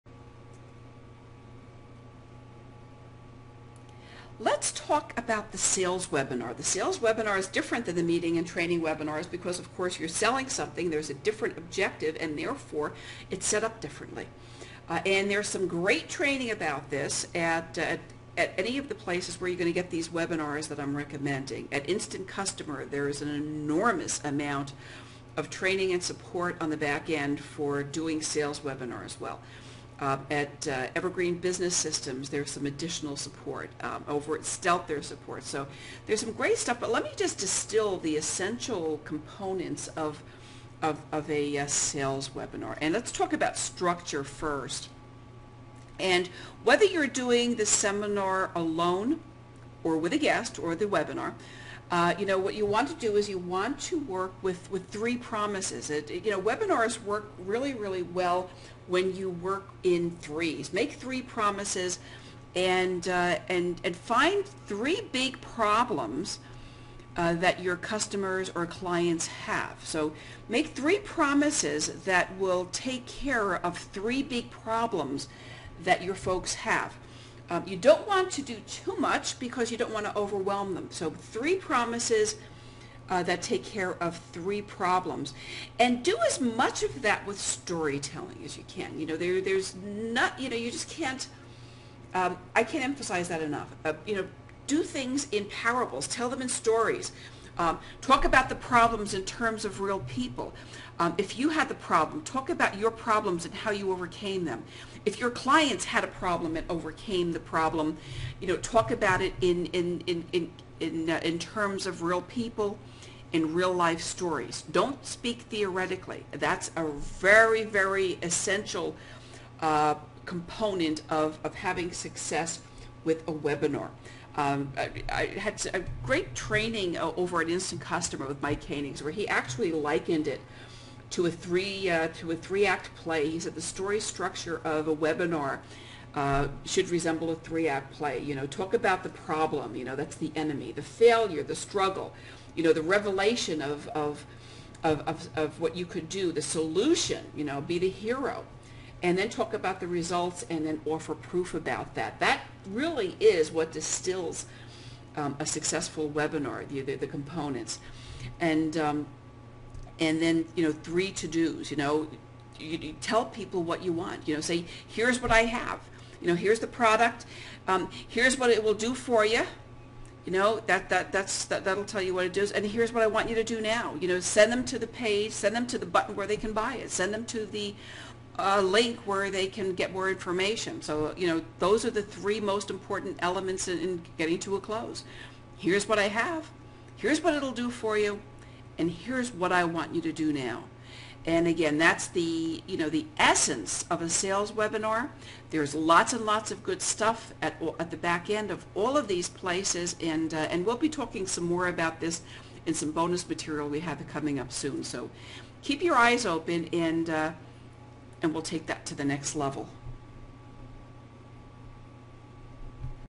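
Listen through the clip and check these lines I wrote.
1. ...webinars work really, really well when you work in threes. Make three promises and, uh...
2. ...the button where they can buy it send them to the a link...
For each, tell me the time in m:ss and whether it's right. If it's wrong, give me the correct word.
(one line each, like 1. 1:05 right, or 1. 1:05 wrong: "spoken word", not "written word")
1. 0:56 right
2. 2:55 right.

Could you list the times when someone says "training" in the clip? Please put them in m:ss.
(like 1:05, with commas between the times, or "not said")
0:08, 0:16, 0:25, 2:06.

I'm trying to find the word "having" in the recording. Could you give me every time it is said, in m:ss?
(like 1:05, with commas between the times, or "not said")
2:01.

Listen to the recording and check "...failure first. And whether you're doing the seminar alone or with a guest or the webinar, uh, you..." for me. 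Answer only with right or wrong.
wrong.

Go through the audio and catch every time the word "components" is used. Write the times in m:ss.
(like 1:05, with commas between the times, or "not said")
0:39, 2:00, 2:37.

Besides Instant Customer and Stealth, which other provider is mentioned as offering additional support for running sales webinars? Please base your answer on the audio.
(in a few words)
Evergreen Business Systems.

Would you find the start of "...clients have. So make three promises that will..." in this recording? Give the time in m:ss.
1:08.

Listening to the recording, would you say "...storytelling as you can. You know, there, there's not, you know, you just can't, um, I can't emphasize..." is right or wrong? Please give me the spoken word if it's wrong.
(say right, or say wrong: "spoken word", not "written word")
right.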